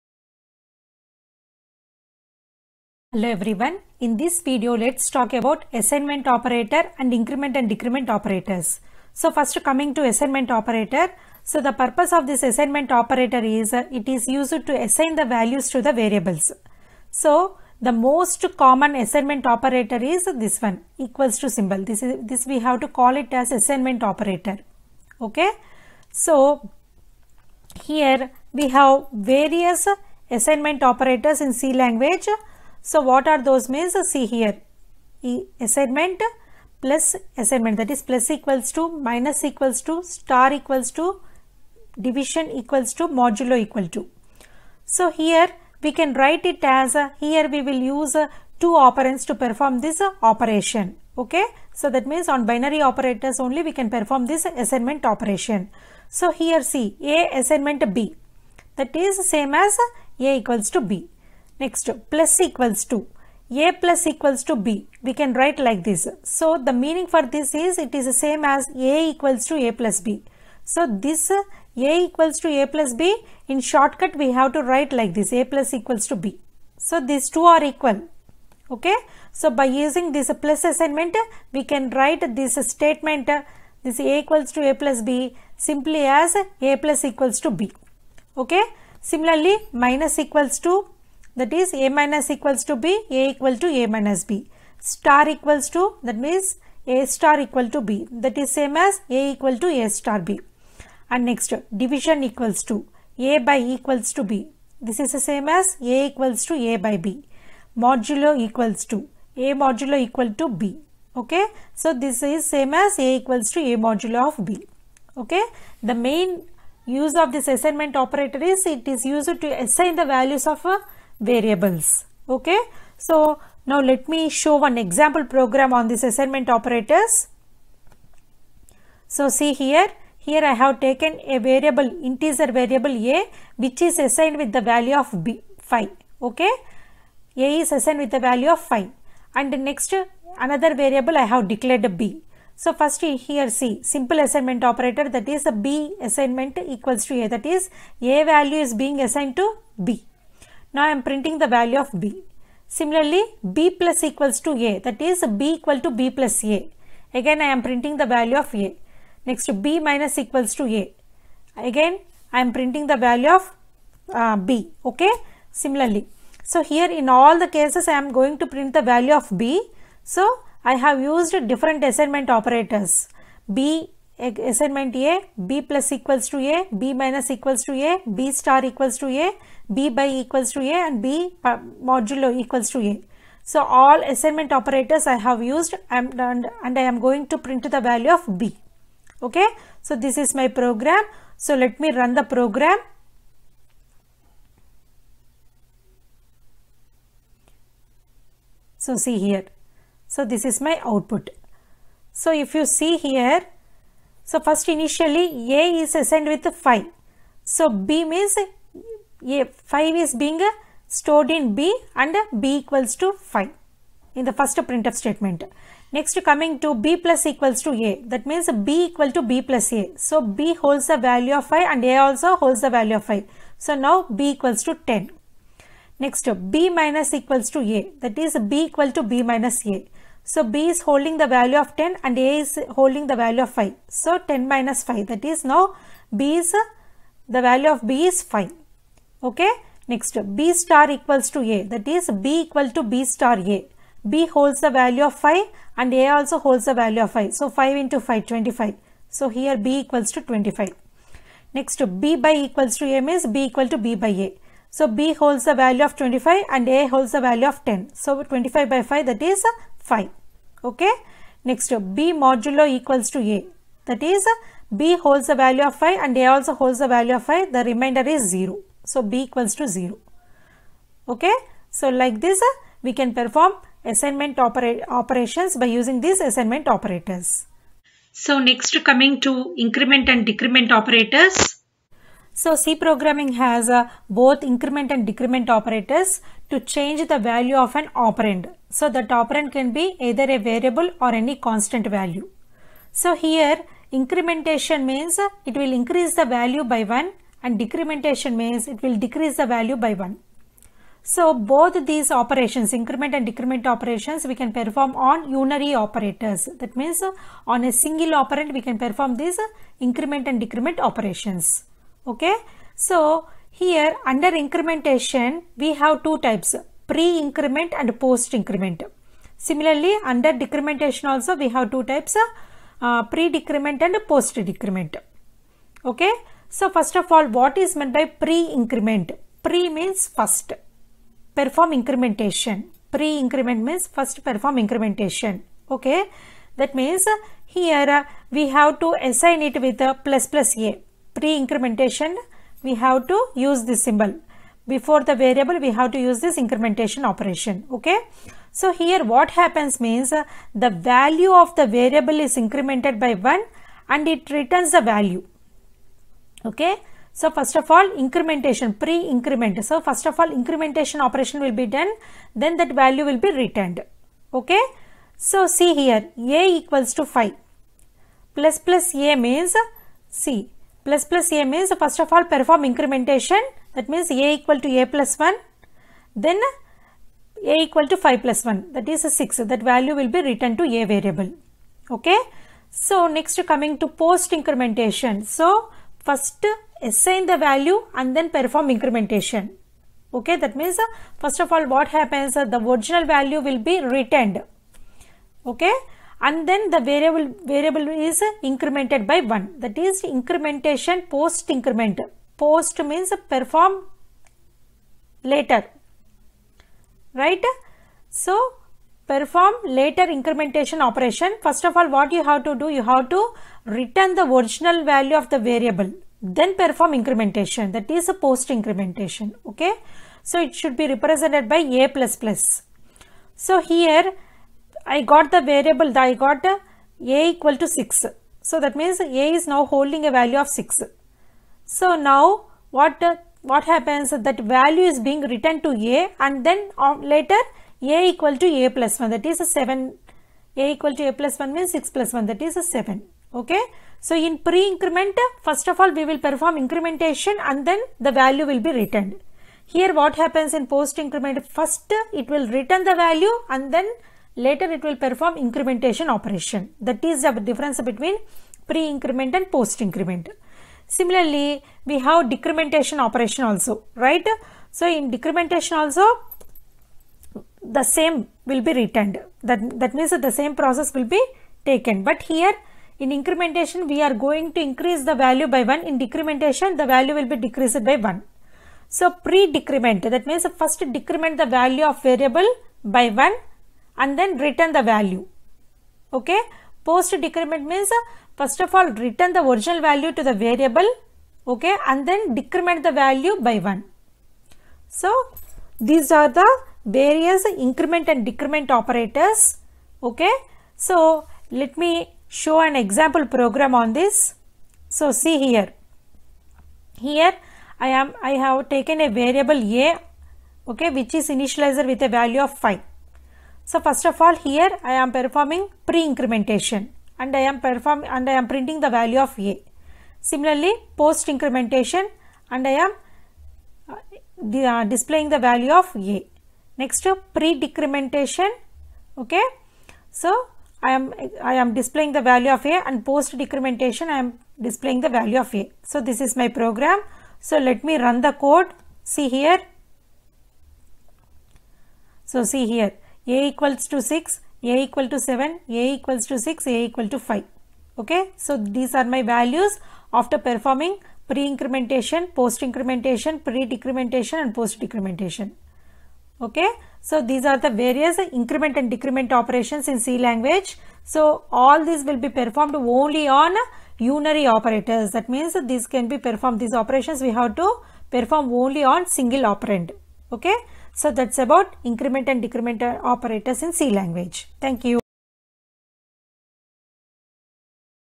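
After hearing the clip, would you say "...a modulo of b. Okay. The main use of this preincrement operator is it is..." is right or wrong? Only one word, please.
wrong.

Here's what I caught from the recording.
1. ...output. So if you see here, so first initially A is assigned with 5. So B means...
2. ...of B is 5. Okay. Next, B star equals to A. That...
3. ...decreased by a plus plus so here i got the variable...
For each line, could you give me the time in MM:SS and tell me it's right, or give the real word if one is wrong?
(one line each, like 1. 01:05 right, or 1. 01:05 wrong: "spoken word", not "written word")
1. 03:20 right
2. 03:57 right
3. 07:00 wrong: "represented", not "decreased".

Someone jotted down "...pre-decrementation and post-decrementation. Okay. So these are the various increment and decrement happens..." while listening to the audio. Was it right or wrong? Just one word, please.
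wrong.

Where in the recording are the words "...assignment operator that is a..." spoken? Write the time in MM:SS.
02:24.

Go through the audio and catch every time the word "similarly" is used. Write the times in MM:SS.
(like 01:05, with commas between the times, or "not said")
01:29, 02:32, 02:45, 05:19, 07:40, 08:40.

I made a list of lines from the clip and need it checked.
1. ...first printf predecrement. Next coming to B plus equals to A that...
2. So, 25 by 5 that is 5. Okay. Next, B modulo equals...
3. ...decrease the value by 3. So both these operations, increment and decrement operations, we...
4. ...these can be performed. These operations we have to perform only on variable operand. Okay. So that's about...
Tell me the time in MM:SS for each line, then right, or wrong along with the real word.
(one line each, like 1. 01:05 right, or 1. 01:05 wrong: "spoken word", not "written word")
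1. 03:34 wrong: "statement", not "predecrement"
2. 04:17 right
3. 04:59 wrong: "1", not "3"
4. 09:25 wrong: "single", not "variable".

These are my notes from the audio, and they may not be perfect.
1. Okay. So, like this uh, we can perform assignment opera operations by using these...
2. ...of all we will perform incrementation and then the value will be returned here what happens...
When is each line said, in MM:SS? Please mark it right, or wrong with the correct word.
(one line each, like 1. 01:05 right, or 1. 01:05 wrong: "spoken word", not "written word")
1. 04:31 right
2. 07:25 right.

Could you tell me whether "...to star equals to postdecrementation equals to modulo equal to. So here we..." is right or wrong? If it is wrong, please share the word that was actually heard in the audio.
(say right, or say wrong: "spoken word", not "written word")
wrong: "division", not "postdecrementation".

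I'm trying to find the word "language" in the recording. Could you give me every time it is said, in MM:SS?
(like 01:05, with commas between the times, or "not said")
00:31, 09:20, 09:33.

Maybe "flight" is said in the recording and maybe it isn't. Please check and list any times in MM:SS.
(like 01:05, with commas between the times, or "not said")
not said.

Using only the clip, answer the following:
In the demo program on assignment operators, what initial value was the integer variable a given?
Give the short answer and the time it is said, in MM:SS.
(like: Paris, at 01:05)
5, at 02:17.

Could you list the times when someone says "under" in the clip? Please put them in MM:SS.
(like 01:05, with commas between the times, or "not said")
05:14, 05:20.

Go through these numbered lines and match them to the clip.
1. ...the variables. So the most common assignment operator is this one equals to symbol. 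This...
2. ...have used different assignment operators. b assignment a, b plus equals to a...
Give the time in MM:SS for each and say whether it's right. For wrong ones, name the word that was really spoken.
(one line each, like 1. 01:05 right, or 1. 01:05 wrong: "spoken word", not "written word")
1. 00:15 right
2. 02:50 right.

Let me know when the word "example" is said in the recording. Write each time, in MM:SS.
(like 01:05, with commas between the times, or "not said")
02:04, 08:22.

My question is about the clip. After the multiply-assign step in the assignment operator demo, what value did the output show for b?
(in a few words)
25.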